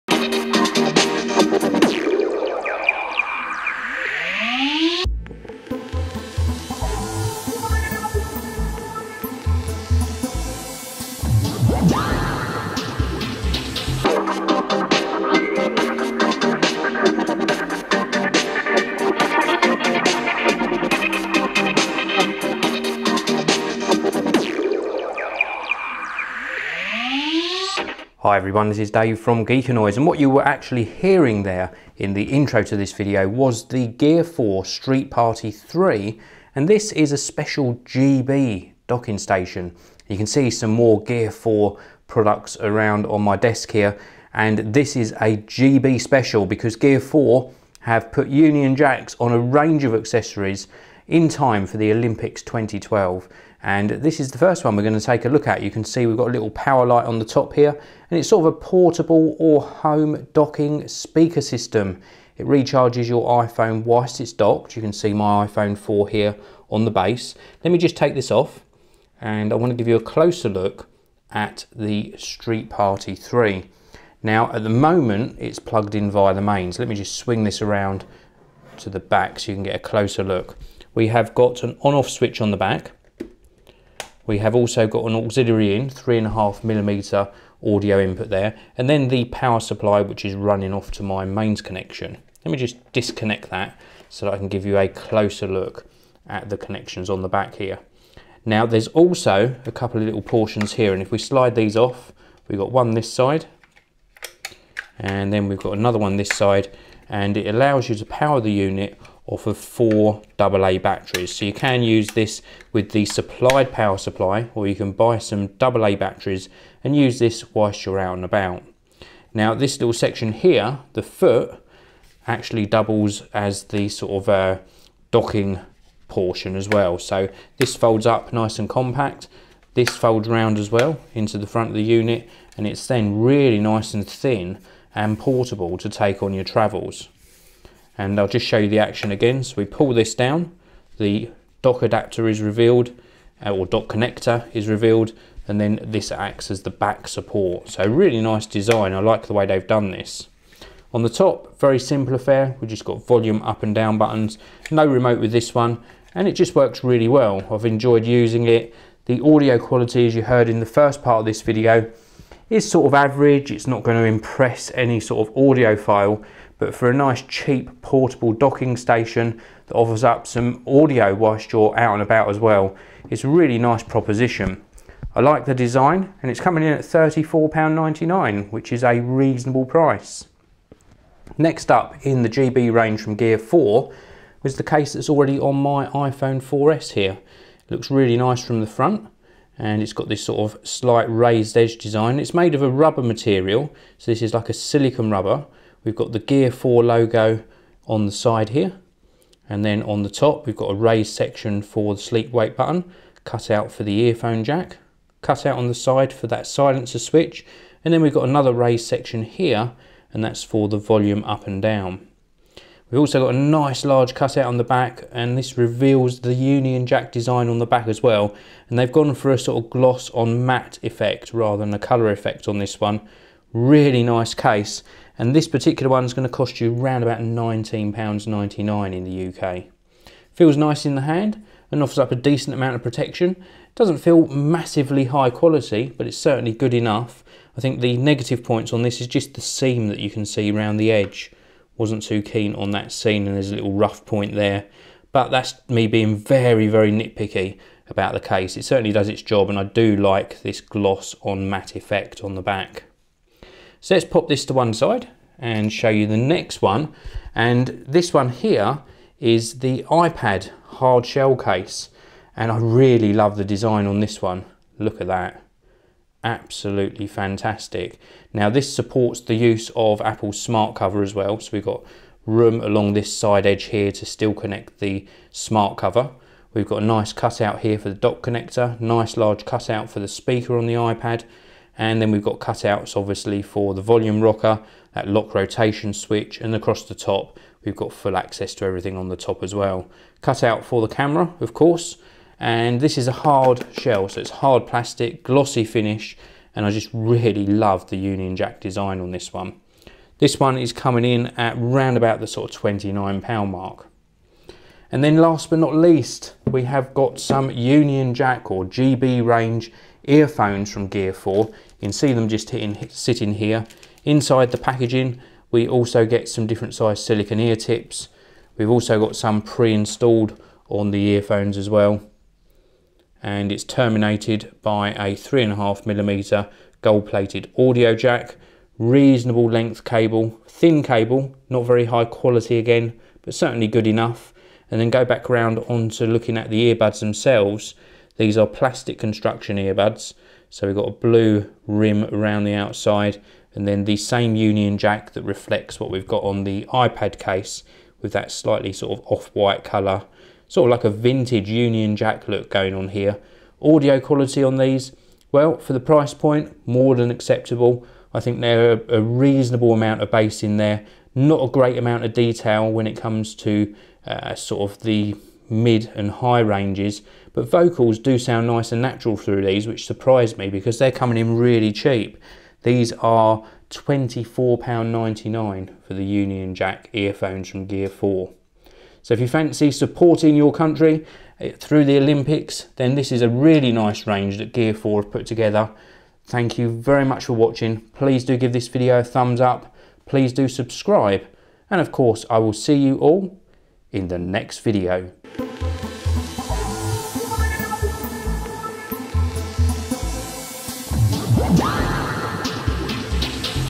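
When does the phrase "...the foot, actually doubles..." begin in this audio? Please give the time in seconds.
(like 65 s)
120 s.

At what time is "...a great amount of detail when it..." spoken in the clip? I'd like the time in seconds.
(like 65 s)
361 s.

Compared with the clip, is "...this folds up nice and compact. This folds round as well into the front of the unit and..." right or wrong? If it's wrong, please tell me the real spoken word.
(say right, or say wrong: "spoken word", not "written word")
right.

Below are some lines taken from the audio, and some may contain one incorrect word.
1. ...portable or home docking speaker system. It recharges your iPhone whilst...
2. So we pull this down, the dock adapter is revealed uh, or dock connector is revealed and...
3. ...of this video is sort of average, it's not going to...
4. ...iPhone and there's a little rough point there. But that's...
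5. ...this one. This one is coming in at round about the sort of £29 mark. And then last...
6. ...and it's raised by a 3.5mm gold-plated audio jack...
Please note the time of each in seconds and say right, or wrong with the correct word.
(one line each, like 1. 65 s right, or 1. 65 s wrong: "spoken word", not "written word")
1. 58 s right
2. 139 s right
3. 161 s right
4. 242 s wrong: "scene", not "iPhone"
5. 299 s right
6. 323 s wrong: "terminated", not "raised".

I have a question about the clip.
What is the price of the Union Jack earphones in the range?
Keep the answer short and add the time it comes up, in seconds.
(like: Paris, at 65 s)
£24.99, at 373 s.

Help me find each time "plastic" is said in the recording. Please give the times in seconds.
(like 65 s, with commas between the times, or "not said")
294 s, 338 s.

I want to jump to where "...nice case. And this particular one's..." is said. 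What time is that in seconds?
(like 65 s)
224 s.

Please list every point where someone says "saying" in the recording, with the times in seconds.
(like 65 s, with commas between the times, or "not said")
not said.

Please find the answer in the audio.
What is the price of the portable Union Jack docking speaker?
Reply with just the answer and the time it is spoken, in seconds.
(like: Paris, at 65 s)
£34.99, at 176 s.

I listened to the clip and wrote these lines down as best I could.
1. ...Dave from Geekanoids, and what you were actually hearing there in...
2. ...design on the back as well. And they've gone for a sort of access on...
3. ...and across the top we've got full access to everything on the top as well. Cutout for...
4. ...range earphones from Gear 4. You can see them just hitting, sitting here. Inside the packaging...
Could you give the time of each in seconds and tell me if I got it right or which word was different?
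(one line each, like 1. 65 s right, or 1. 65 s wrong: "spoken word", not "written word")
1. 28 s right
2. 217 s wrong: "gloss", not "access"
3. 286 s right
4. 309 s right.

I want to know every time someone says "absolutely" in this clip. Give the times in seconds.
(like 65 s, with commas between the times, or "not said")
266 s.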